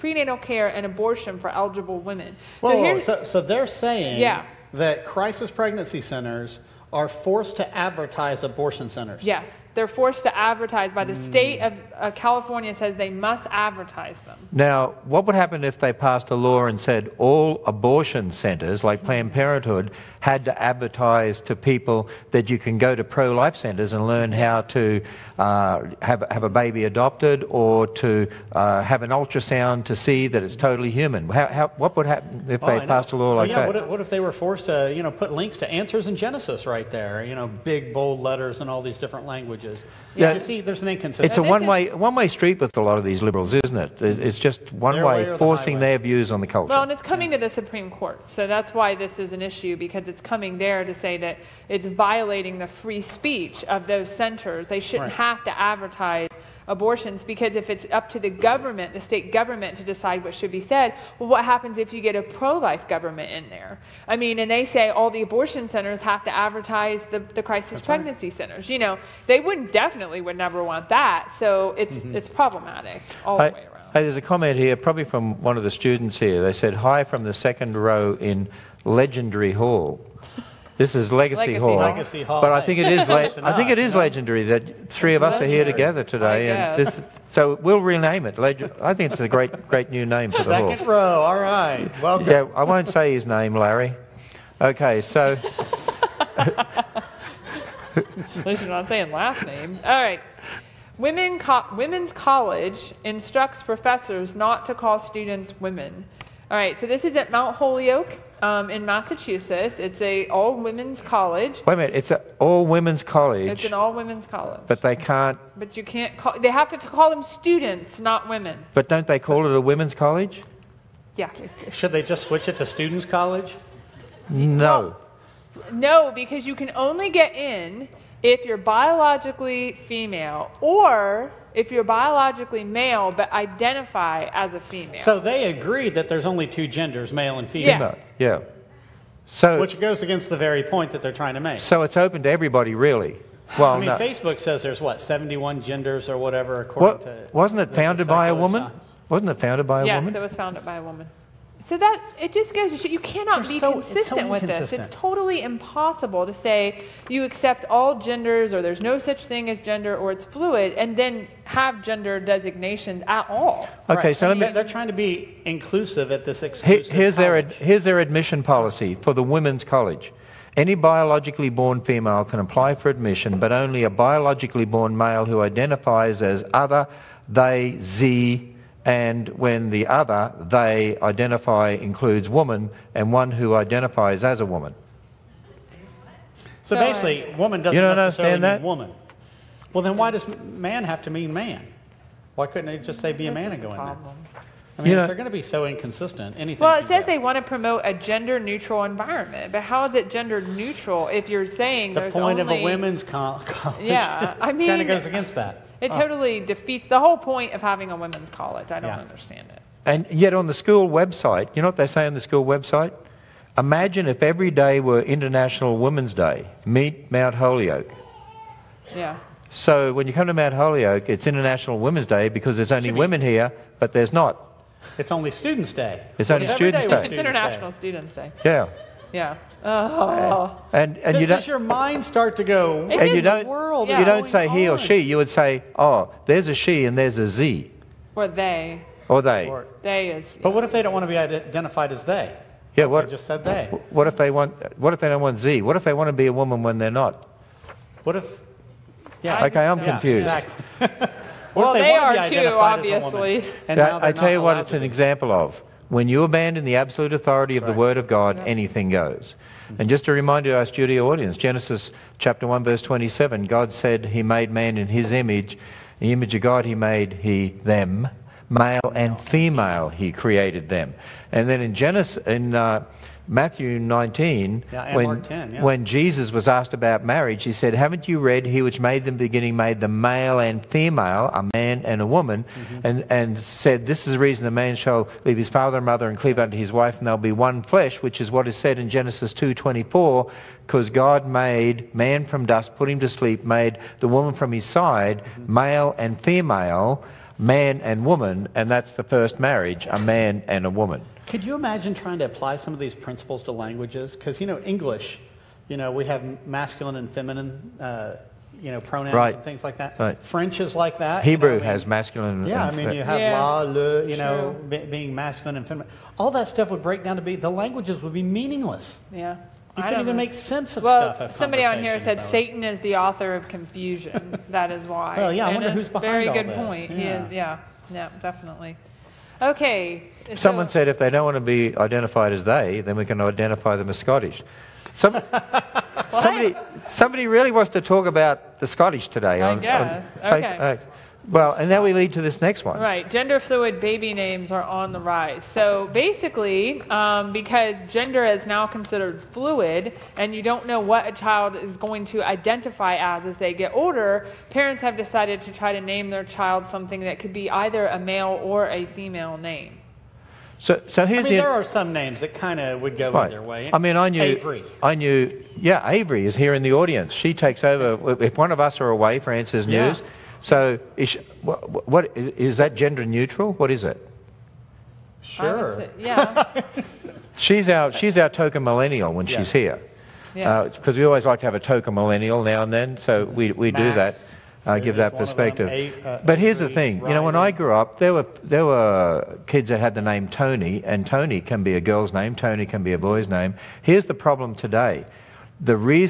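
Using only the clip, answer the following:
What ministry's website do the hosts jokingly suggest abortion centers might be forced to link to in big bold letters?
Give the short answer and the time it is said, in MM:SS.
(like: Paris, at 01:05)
Answers in Genesis, at 00:35.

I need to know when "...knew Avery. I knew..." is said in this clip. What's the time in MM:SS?
06:04.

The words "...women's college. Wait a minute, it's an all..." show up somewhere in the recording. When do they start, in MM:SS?
01:50.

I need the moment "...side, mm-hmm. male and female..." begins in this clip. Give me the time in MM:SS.
04:54.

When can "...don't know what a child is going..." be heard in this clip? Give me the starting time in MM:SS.
05:50.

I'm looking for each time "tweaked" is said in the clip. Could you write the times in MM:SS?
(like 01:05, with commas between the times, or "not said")
not said.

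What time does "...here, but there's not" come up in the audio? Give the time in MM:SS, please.
03:43.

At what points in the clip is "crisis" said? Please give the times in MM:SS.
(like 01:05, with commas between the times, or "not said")
00:05, 01:07.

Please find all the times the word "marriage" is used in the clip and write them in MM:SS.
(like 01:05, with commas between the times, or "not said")
04:37, 04:59.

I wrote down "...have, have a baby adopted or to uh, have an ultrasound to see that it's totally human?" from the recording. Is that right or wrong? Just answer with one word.
right.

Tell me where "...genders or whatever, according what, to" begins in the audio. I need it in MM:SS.
02:25.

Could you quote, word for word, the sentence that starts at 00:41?
It's a one-way one-way street with a lot of these liberals, isn't it?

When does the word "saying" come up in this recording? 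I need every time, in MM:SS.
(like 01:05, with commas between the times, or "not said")
00:03, 01:38, 03:21.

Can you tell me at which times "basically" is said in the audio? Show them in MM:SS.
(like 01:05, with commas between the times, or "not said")
03:06, 05:45.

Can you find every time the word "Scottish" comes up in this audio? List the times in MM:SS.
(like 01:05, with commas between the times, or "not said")
05:33, 05:38.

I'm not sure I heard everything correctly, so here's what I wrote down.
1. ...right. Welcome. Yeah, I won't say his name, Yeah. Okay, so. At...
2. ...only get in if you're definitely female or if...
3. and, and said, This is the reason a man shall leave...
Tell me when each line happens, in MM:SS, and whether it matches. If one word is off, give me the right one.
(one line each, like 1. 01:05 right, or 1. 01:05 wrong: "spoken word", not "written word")
1. 01:31 wrong: "Larry", not "Yeah"
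2. 02:06 wrong: "biologically", not "definitely"
3. 04:42 right.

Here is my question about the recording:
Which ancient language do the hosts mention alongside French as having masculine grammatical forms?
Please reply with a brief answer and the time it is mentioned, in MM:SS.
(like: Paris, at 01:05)
Hebrew, at 05:11.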